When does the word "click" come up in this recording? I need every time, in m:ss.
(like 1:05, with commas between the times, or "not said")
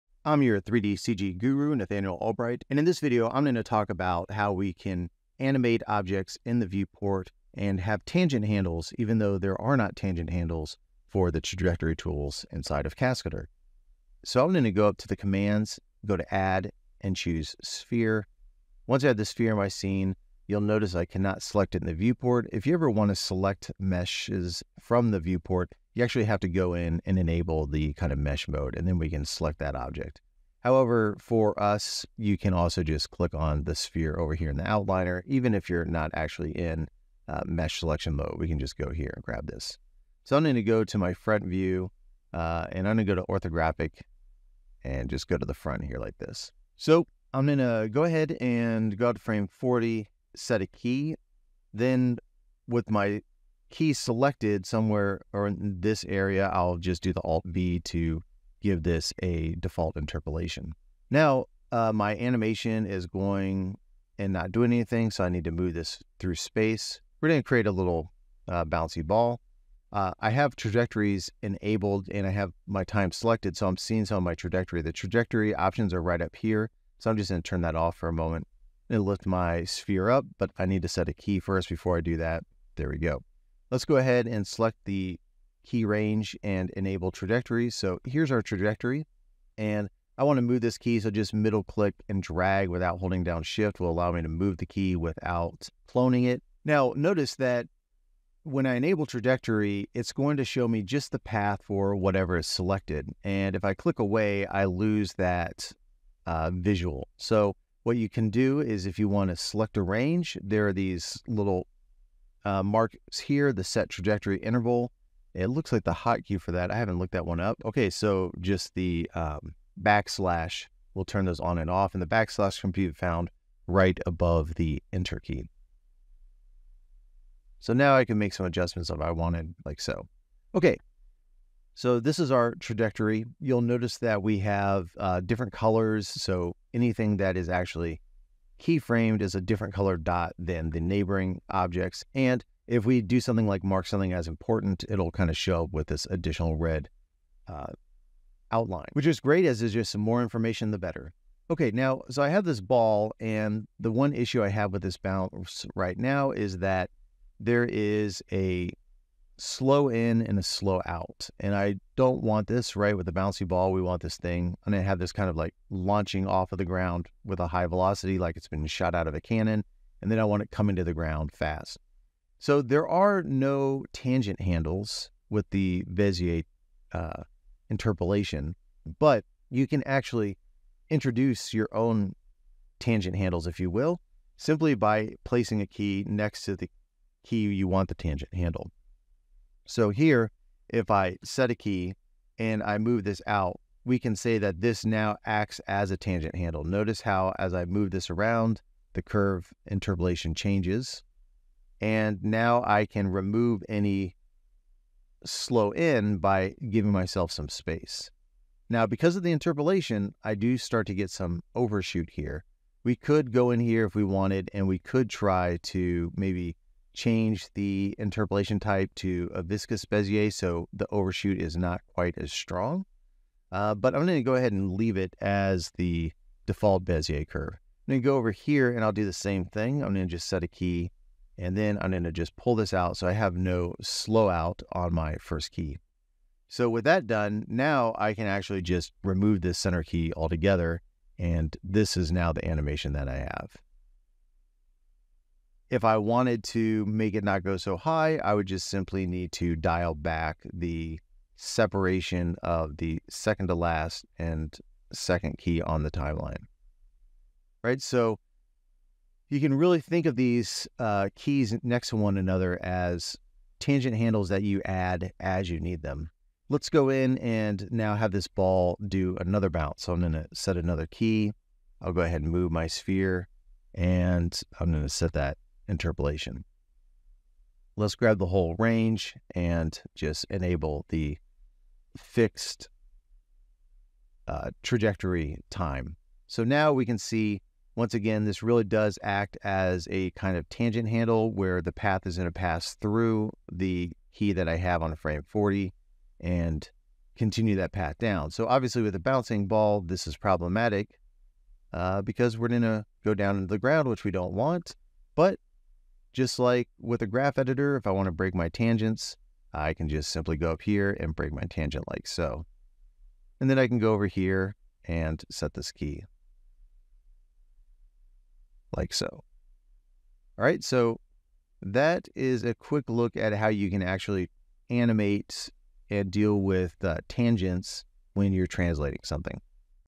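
0:33, 1:31, 1:43.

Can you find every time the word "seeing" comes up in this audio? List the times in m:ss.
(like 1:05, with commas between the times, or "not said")
1:13.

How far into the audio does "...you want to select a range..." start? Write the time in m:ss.
1:48.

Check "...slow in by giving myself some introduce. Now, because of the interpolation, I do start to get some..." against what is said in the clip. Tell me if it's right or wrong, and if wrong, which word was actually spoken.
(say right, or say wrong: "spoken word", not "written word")
wrong: "space", not "introduce".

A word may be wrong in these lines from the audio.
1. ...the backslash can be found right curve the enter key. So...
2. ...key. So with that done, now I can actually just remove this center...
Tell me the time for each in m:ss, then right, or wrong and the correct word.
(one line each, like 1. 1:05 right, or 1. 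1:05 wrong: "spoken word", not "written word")
1. 2:02 wrong: "above", not "curve"
2. 3:55 right.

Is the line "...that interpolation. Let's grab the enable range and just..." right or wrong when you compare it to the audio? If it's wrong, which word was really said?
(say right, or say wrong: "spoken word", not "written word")
wrong: "whole", not "enable".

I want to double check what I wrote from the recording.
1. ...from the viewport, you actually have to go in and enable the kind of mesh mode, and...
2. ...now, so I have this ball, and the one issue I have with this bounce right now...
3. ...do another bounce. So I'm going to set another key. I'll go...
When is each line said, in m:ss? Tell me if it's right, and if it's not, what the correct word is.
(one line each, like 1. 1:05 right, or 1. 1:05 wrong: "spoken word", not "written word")
1. 0:24 right
2. 2:31 right
3. 4:28 right.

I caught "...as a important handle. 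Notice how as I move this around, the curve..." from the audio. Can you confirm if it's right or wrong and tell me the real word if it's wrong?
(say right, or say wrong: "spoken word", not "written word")
wrong: "tangent", not "important".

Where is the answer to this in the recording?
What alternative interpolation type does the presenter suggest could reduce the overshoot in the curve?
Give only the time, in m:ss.
3:39.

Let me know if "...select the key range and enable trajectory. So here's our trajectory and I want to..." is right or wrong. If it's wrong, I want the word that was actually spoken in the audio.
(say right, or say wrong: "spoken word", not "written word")
right.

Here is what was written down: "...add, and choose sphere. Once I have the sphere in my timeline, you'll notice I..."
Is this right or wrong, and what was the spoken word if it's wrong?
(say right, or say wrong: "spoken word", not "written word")
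wrong: "scene", not "timeline".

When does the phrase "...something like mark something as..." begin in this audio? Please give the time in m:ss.
2:23.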